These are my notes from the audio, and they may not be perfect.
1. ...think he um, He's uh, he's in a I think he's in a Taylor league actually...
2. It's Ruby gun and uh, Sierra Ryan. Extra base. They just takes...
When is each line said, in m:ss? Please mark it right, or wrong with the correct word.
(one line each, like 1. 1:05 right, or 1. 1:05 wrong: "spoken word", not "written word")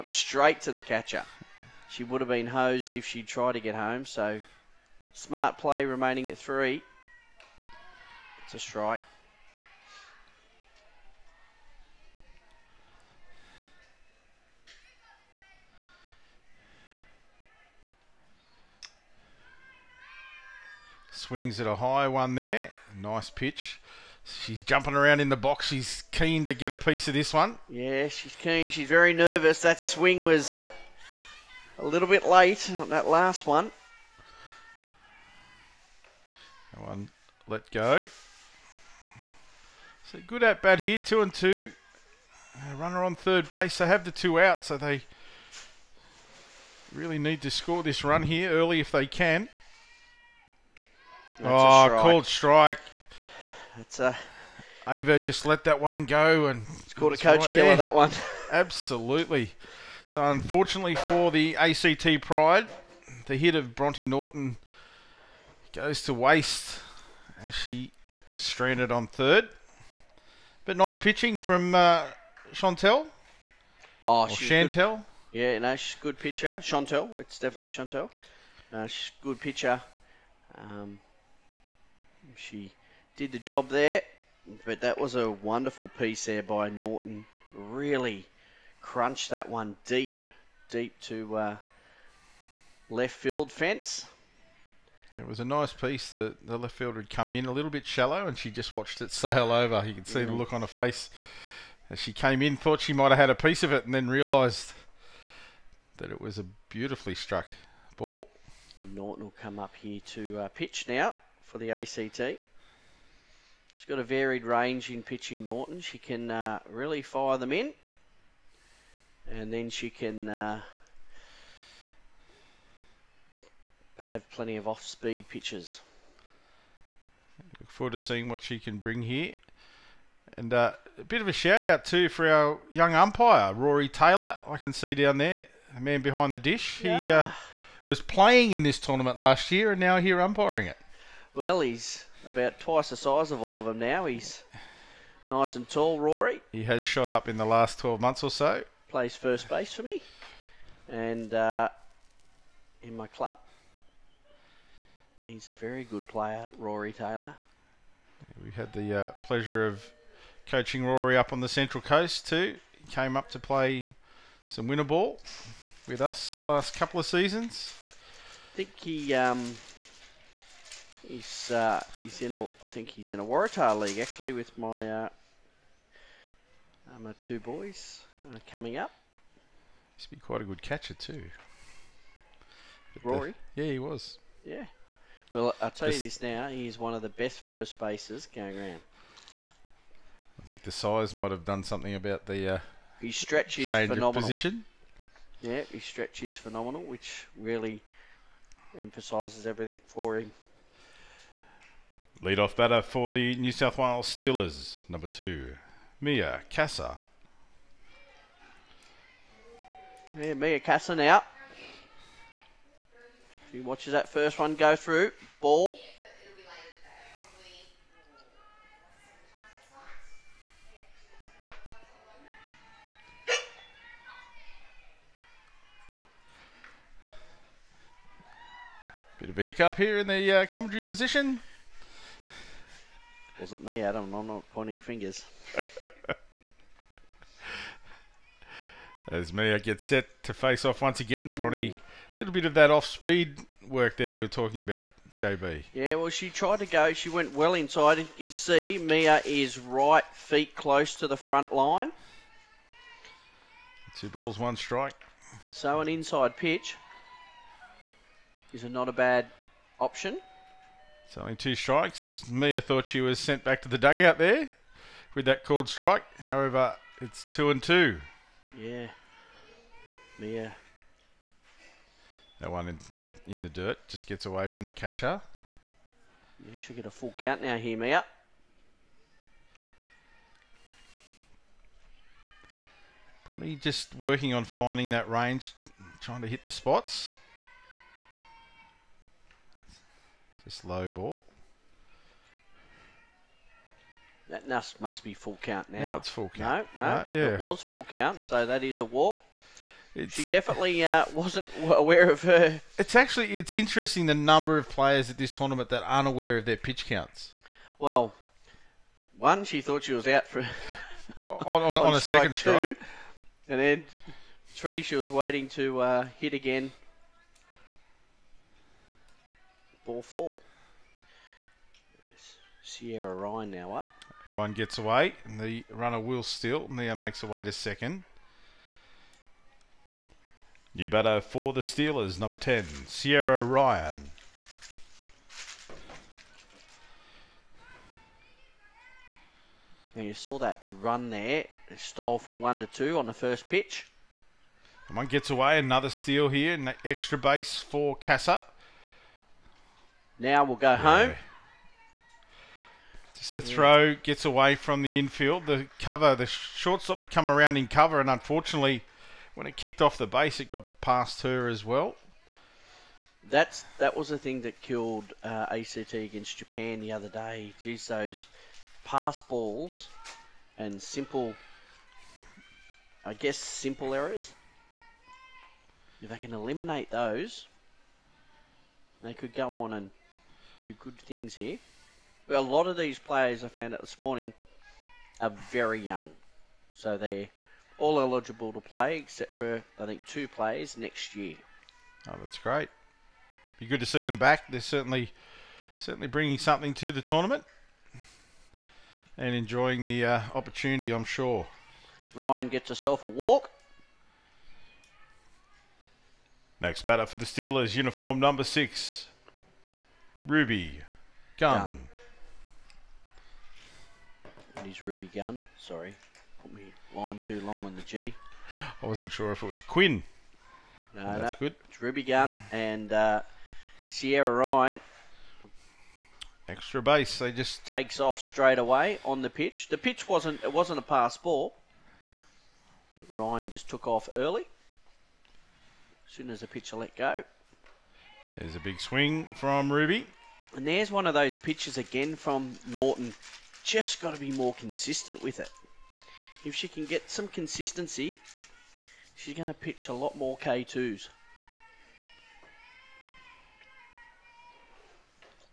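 1. 2:48 wrong: "Waratah", not "Taylor"
2. 7:01 right.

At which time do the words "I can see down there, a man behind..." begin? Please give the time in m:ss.
2:14.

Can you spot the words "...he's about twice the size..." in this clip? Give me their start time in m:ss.
2:21.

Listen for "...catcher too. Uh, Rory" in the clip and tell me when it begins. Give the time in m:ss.
3:00.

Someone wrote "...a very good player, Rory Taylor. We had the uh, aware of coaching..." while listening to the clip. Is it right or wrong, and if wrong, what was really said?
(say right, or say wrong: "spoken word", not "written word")
wrong: "pleasure", not "aware".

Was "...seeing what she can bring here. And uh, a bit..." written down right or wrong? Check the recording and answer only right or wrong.
right.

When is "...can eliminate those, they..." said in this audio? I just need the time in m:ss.
6:16.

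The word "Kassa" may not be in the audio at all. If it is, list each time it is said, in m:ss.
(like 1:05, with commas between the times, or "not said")
3:26, 3:30.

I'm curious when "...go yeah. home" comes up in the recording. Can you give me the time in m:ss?
5:50.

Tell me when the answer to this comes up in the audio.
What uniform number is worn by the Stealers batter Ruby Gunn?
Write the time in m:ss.
6:48.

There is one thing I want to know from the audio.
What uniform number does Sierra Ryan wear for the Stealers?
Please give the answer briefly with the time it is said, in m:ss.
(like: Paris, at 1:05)
10, at 5:32.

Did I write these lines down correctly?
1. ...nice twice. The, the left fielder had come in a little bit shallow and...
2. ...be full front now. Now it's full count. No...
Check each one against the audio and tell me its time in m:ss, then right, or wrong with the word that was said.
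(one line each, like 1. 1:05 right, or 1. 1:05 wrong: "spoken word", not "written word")
1. 1:35 wrong: "piece", not "twice"
2. 4:55 wrong: "count", not "front".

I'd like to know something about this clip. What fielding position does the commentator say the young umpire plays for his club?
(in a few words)
First base.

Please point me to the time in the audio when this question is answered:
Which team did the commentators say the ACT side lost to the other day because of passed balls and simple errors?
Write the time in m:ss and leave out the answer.
6:06.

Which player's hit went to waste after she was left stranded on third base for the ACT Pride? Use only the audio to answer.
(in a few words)
Bronte Norton.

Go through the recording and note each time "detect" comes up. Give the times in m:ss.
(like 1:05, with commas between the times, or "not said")
not said.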